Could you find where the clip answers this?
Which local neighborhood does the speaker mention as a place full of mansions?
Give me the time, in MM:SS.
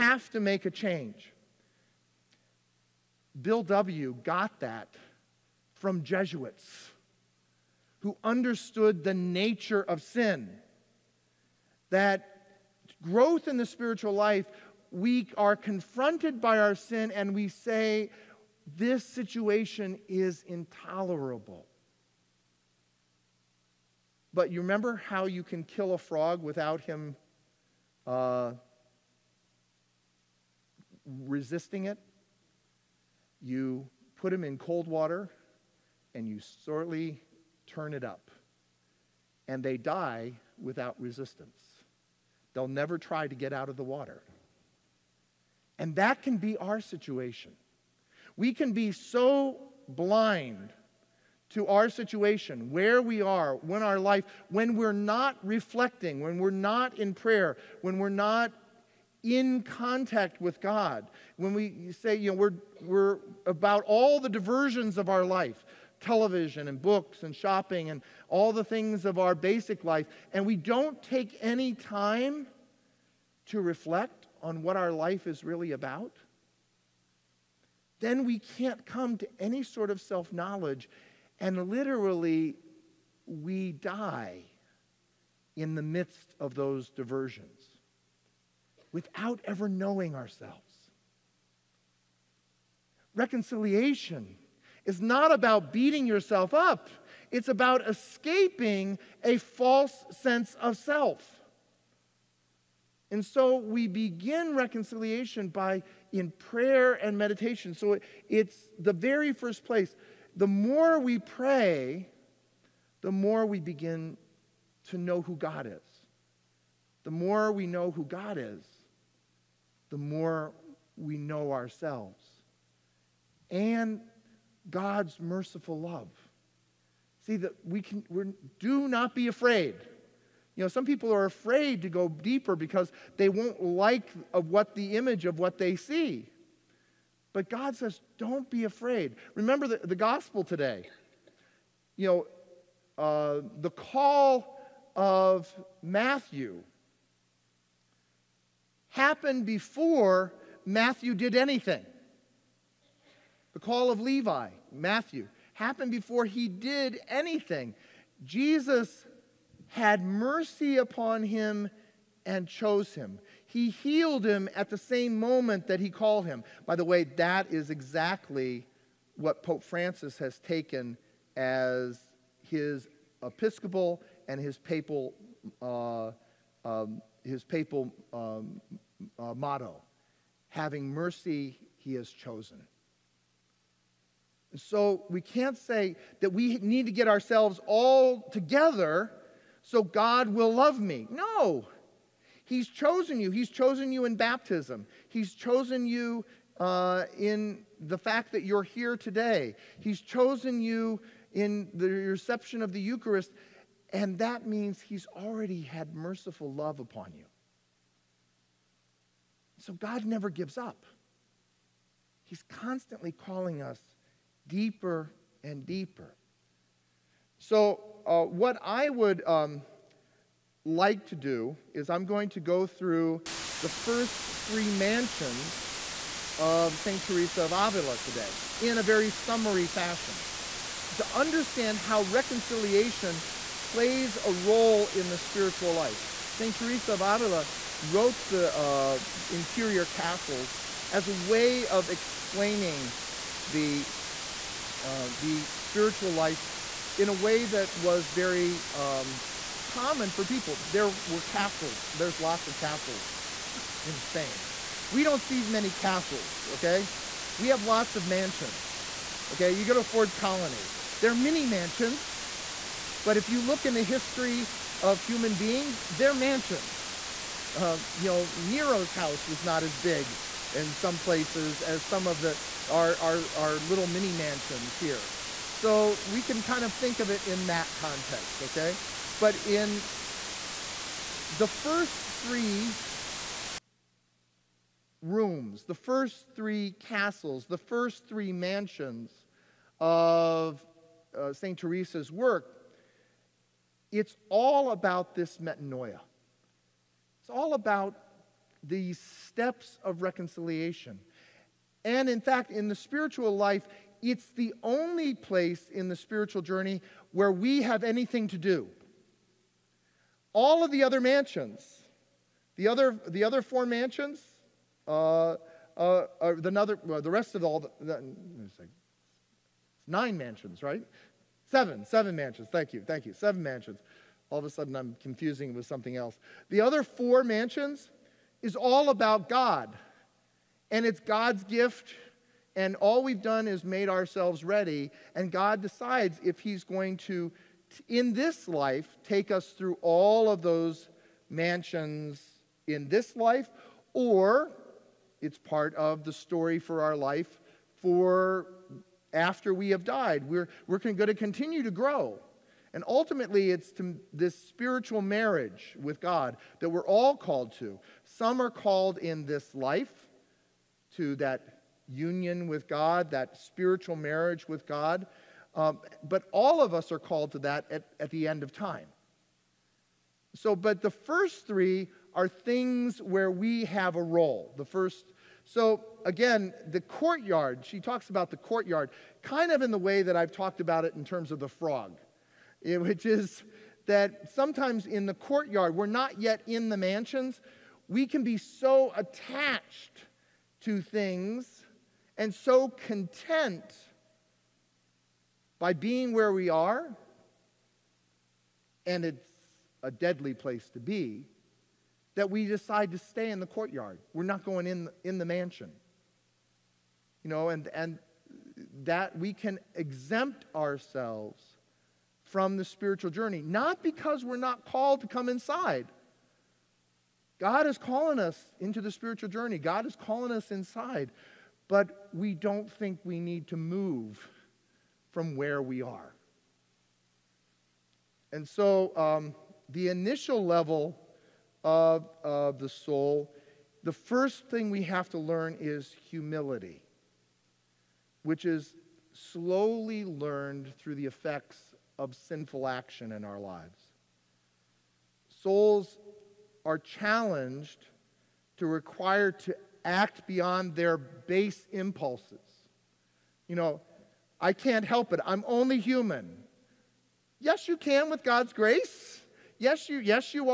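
04:19.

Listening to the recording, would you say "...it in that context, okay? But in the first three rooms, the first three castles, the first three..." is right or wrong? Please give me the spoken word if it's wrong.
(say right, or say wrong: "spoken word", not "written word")
right.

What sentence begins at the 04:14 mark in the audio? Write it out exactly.
We don't see many castles, okay?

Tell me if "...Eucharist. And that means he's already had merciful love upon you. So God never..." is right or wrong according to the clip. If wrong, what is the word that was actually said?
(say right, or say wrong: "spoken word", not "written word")
right.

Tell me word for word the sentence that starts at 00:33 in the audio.
You put him in cold water and you slowly turn it up.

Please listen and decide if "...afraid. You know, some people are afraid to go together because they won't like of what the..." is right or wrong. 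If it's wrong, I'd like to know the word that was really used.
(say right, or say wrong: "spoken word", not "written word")
wrong: "deeper", not "together".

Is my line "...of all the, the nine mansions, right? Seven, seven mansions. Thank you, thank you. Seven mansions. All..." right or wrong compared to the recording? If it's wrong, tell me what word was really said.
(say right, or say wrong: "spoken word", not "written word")
right.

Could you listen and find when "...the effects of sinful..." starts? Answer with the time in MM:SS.
07:20.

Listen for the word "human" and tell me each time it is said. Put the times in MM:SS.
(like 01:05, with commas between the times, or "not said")
04:25, 07:35.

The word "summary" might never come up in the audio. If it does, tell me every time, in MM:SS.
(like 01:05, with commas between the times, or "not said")
03:49.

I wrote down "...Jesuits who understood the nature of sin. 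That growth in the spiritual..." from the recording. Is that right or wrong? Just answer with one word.
right.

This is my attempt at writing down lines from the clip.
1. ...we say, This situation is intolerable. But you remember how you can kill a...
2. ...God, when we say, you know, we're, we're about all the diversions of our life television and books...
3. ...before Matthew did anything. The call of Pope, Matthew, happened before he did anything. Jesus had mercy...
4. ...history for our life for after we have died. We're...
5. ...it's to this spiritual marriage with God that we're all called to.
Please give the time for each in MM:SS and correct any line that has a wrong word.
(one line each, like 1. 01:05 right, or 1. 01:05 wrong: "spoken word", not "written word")
1. 00:17 right
2. 01:00 right
3. 02:29 wrong: "Levi", not "Pope"
4. 05:46 wrong: "story", not "history"
5. 05:53 right.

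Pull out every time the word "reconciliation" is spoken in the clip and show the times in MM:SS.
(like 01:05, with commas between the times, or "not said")
01:33, 01:44, 03:52, 05:00.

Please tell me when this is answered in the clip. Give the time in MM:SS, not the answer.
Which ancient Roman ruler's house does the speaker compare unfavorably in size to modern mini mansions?
04:28.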